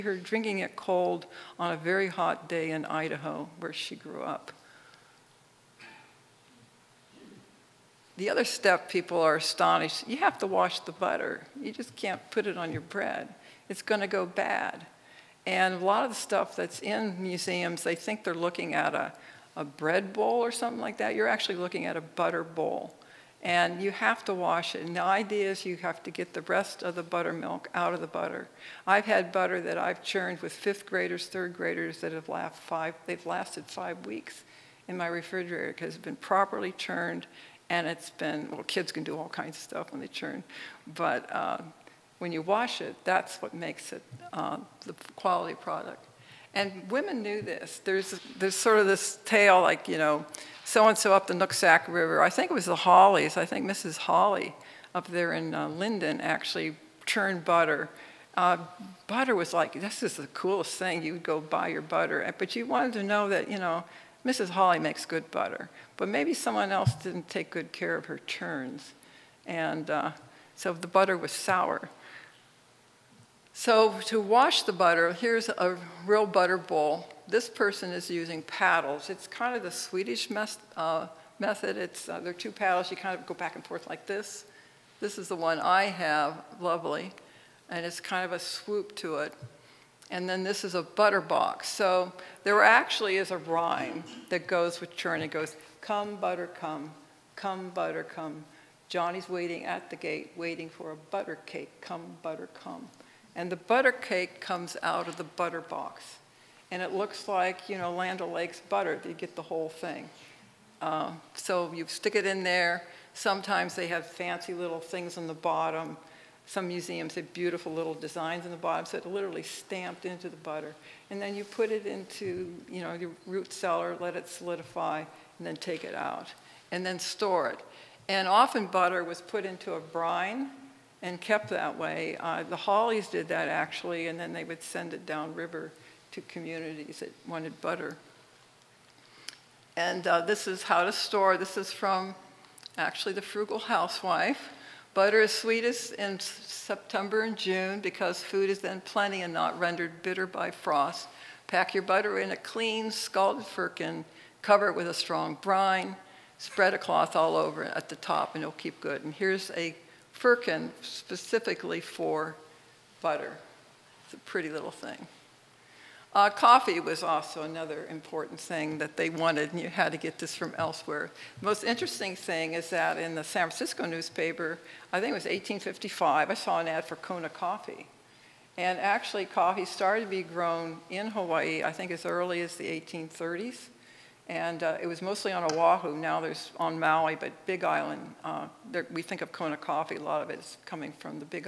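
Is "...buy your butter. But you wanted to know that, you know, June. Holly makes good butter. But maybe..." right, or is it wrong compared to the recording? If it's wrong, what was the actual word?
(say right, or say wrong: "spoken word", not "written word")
wrong: "Mrs", not "June".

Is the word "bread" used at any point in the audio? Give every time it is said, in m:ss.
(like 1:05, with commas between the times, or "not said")
0:12, 0:19.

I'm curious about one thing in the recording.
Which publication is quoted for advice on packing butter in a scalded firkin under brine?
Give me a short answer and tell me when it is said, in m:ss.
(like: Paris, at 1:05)
the Frugal Housewife, at 2:23.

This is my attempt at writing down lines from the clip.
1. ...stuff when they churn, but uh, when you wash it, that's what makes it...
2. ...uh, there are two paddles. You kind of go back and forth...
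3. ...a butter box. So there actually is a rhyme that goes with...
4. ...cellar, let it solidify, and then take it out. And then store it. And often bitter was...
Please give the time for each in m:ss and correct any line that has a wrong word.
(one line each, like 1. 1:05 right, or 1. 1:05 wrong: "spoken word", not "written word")
1. 0:39 right
2. 1:22 right
3. 1:30 right
4. 2:03 wrong: "butter", not "bitter".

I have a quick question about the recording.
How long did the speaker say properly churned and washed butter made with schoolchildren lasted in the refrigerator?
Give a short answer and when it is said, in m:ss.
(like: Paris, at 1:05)
5 weeks, at 0:33.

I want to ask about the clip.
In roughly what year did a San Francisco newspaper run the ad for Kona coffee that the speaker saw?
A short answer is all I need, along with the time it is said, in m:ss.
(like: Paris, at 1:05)
1855, at 2:55.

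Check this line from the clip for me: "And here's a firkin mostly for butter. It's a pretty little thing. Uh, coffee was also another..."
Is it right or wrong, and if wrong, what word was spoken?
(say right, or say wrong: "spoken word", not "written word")
wrong: "specifically", not "mostly".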